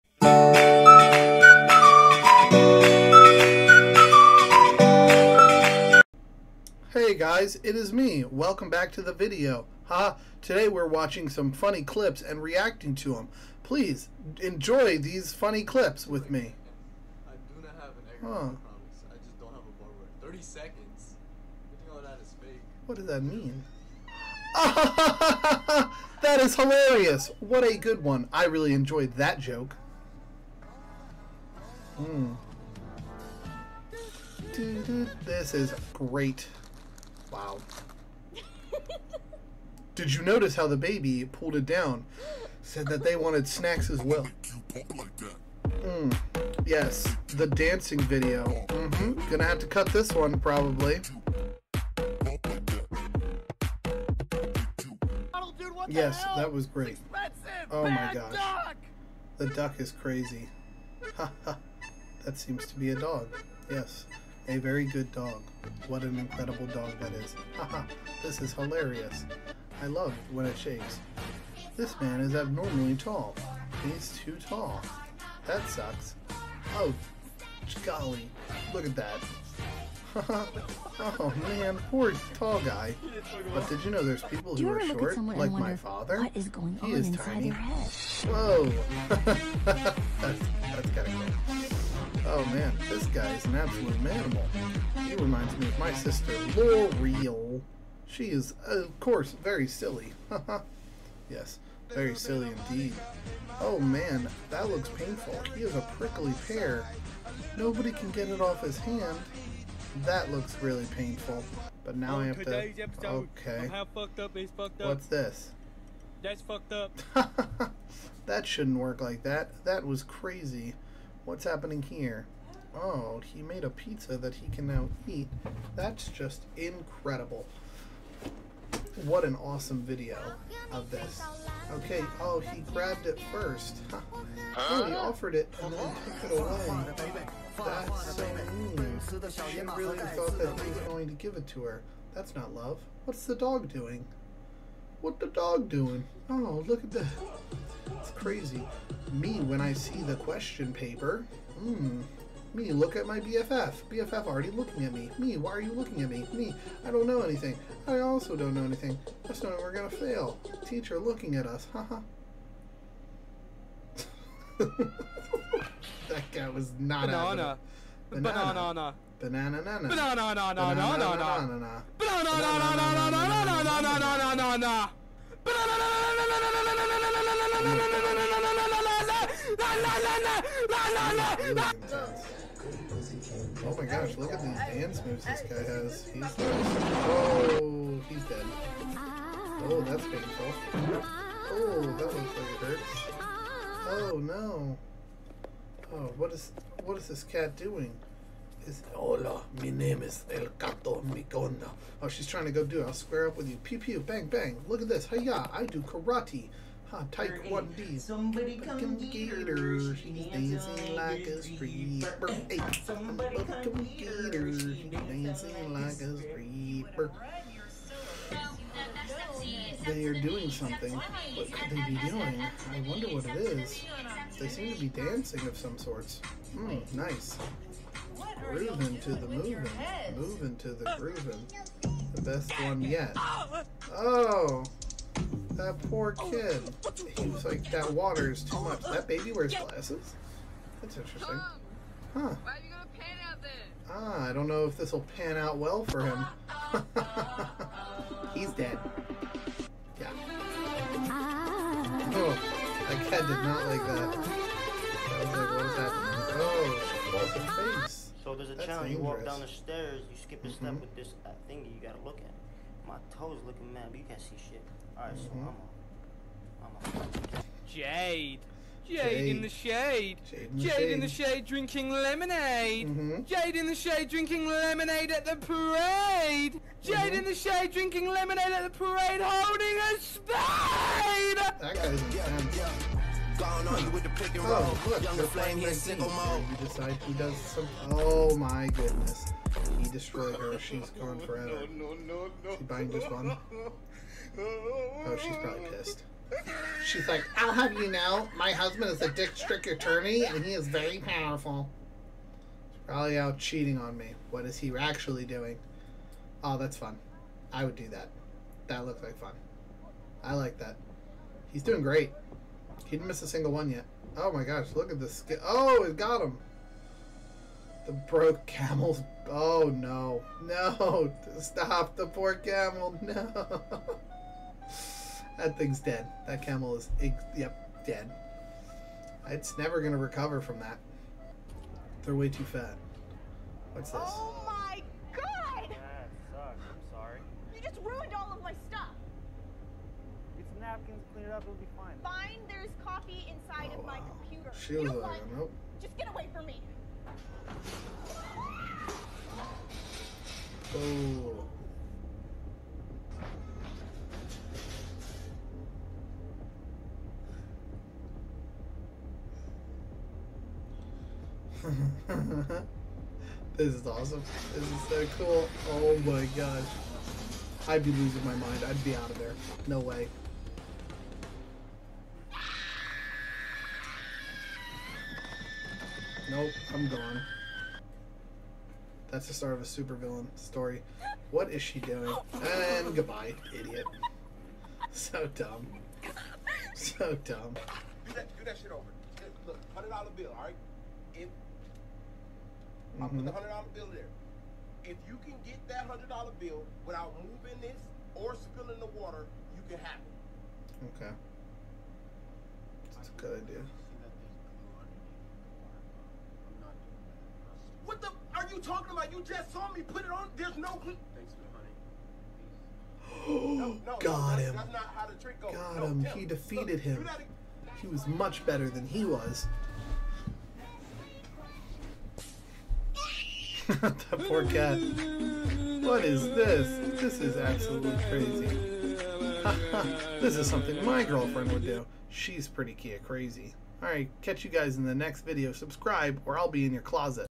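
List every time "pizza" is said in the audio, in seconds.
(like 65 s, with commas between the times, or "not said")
123 s.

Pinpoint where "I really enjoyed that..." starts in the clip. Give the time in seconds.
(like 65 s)
28 s.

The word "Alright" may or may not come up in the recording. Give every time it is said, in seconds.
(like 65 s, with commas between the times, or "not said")
264 s, 433 s.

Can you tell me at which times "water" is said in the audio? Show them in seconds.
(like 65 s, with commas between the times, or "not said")
237 s, 398 s.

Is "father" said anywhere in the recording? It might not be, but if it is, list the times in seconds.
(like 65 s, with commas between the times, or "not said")
85 s.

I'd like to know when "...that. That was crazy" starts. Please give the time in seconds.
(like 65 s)
119 s.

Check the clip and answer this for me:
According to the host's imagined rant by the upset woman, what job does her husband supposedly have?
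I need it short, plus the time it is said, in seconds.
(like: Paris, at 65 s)
district attorney, at 299 s.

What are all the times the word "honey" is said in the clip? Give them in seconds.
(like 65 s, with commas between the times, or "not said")
413 s.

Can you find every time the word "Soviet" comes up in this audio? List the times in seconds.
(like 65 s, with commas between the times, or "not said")
not said.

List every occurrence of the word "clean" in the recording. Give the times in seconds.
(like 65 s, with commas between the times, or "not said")
341 s.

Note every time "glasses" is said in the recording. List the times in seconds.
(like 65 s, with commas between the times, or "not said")
239 s.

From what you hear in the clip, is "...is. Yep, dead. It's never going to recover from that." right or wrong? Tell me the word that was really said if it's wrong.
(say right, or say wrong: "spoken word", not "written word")
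right.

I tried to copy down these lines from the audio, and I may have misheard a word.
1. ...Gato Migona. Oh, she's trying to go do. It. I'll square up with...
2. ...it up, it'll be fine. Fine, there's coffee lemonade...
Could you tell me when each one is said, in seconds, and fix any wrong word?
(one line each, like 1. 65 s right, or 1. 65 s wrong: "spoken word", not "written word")
1. 200 s right
2. 341 s wrong: "inside", not "lemonade".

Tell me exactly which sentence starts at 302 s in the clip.
He's probably out cheating on me.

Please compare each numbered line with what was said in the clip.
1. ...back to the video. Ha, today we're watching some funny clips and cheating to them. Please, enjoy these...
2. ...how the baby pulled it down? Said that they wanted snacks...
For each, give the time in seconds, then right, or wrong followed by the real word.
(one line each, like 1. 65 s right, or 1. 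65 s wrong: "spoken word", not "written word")
1. 8 s wrong: "reacting", not "cheating"
2. 40 s right.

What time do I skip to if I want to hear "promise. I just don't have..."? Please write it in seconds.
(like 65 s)
18 s.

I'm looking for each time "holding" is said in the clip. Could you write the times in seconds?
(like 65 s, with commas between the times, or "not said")
279 s.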